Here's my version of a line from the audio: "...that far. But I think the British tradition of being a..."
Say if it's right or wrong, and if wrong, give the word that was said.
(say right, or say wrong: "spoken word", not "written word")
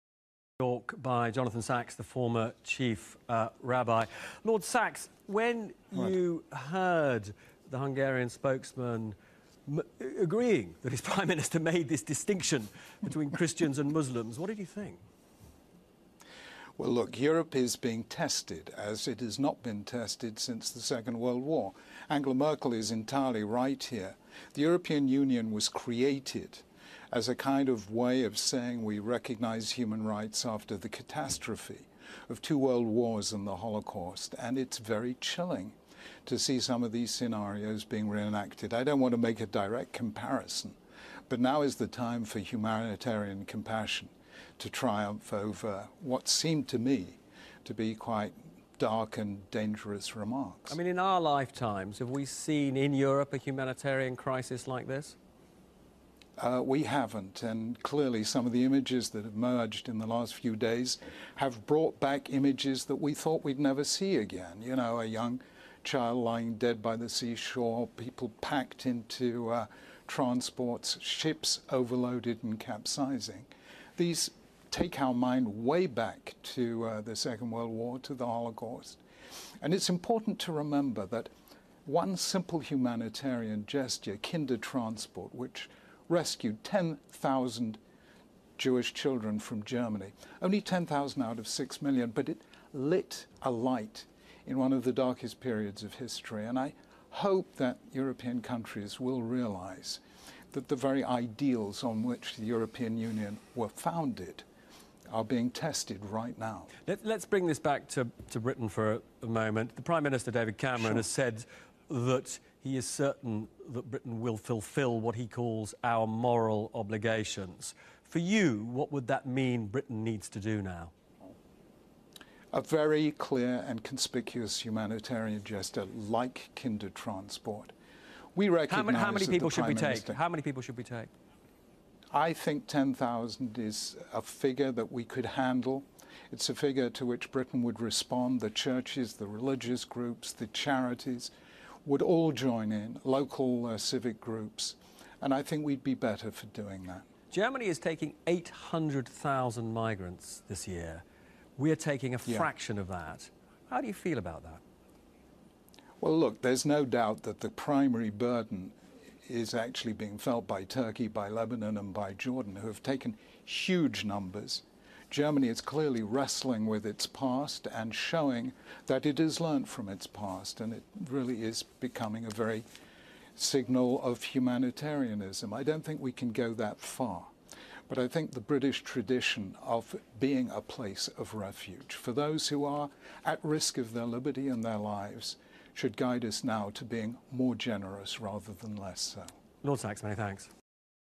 right.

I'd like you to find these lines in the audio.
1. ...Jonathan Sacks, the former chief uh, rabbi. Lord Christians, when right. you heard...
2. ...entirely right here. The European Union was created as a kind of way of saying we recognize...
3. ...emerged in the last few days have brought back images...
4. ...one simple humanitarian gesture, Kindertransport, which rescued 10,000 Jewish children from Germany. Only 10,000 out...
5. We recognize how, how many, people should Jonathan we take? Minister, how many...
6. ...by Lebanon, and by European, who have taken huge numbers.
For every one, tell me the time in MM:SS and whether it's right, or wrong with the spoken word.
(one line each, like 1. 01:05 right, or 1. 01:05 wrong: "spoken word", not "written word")
1. 00:01 wrong: "Sacks", not "Christians"
2. 00:22 right
3. 00:59 right
4. 01:21 right
5. 02:08 wrong: "Prime", not "Jonathan"
6. 02:41 wrong: "Jordan", not "European".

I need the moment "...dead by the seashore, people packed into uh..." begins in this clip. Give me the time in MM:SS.
01:06.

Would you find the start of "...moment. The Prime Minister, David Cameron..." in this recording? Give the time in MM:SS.
01:49.